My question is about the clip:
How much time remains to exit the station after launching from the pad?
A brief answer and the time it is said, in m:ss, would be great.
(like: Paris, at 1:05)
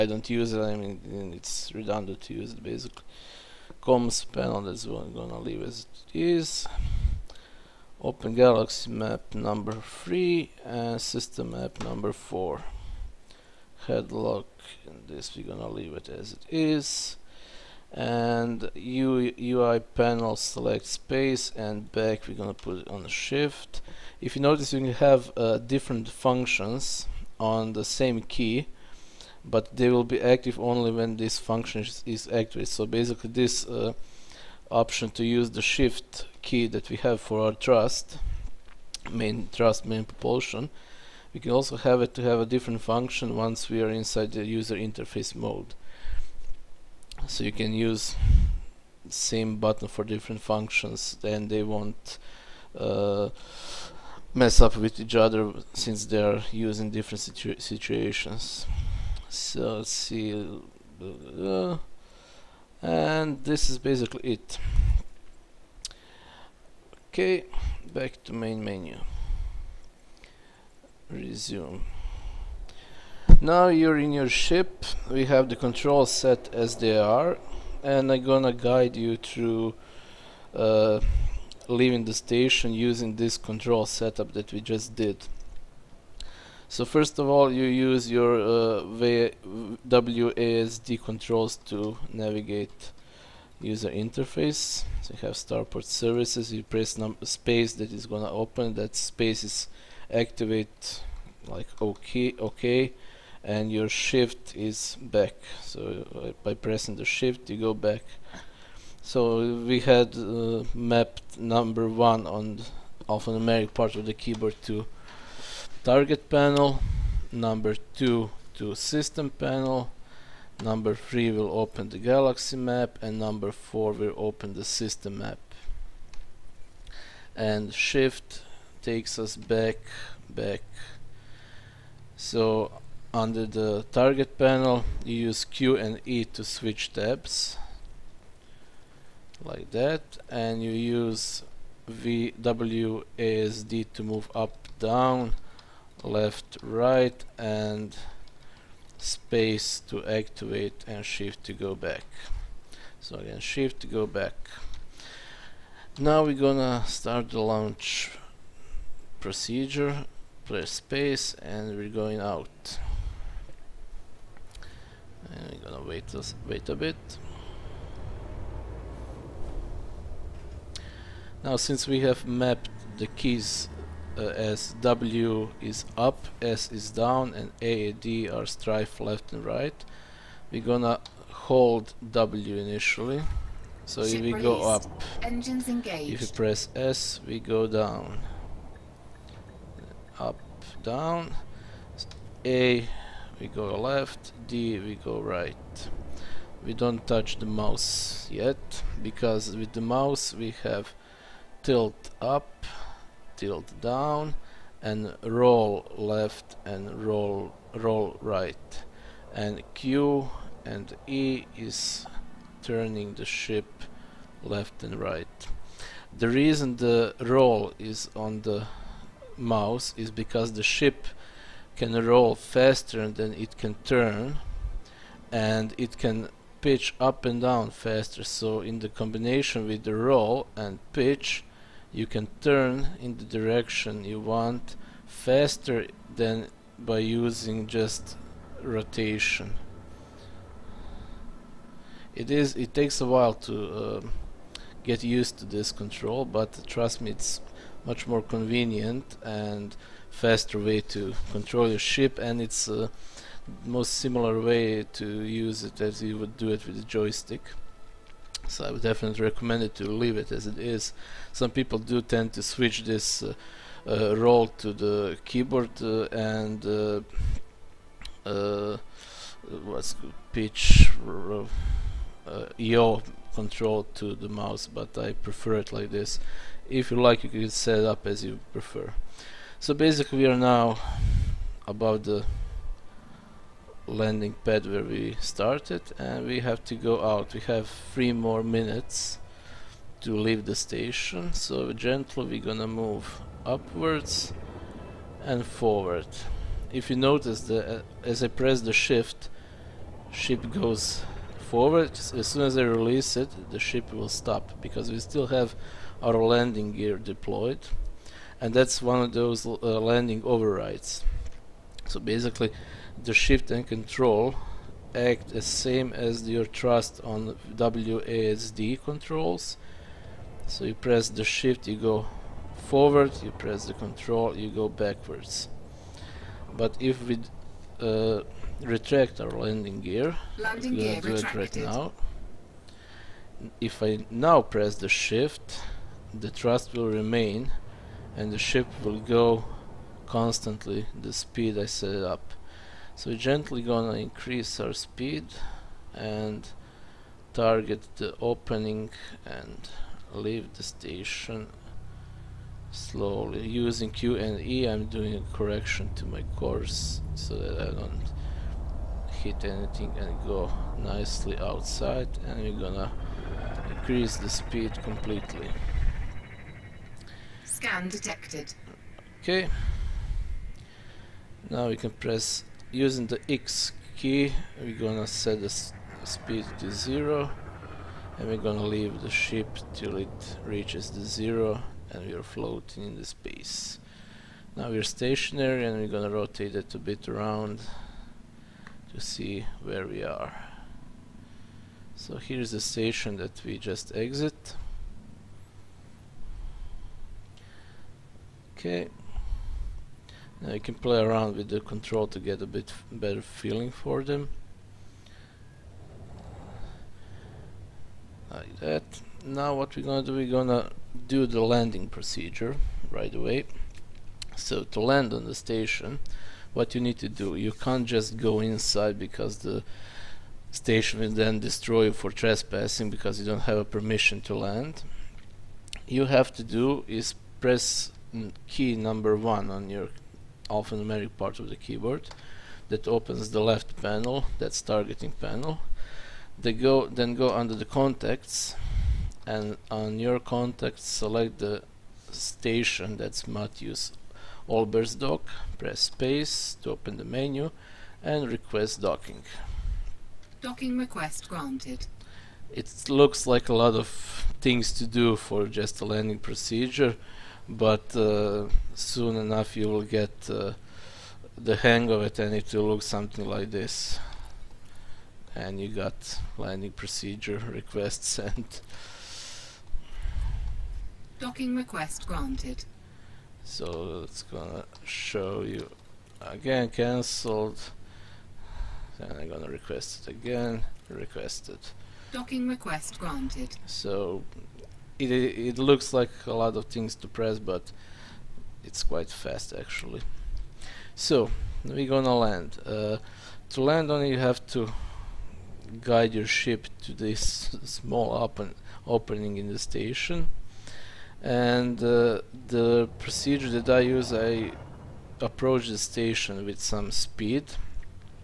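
3 minutes, at 4:47.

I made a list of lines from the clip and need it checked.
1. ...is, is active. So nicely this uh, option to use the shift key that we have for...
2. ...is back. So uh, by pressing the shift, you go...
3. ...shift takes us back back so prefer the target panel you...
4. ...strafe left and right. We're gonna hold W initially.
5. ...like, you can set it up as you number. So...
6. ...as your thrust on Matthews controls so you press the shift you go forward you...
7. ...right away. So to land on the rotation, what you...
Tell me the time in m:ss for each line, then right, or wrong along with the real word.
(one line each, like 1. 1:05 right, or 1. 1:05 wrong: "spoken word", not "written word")
1. 0:31 wrong: "basically", not "nicely"
2. 1:44 right
3. 2:07 wrong: "under", not "prefer"
4. 2:58 right
5. 4:37 wrong: "prefer", not "number"
6. 5:15 wrong: "WASD", not "Matthews"
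7. 6:52 wrong: "station", not "rotation".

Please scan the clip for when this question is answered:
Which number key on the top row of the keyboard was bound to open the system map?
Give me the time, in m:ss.
2:03.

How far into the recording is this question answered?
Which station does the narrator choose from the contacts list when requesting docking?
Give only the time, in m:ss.
7:23.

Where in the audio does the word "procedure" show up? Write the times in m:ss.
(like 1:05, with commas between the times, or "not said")
2:39, 6:51, 7:36, 7:46, 8:22.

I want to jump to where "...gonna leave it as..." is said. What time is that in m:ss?
0:15.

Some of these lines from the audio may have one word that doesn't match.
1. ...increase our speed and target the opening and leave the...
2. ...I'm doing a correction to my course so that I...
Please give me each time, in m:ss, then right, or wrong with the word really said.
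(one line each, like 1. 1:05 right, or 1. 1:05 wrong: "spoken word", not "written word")
1. 5:43 right
2. 5:54 right.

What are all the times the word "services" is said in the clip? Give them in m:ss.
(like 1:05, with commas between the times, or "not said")
1:35.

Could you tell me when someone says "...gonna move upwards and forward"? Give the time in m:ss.
4:52.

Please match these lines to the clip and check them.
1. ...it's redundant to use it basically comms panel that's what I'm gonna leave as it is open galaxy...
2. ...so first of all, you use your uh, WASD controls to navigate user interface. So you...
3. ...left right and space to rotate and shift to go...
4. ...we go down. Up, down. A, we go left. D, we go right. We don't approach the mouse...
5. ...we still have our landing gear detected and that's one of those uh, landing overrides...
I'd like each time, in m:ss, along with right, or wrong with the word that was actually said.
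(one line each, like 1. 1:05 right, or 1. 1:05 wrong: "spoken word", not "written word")
1. 0:01 right
2. 1:26 right
3. 2:26 wrong: "activate", not "rotate"
4. 3:07 wrong: "touch", not "approach"
5. 5:04 wrong: "deployed", not "detected".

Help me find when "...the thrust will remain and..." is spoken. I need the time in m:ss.
5:36.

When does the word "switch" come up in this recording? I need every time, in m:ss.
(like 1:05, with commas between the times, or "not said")
2:16, 4:22.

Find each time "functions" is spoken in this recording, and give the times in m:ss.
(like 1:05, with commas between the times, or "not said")
0:26, 0:31, 0:42, 0:50.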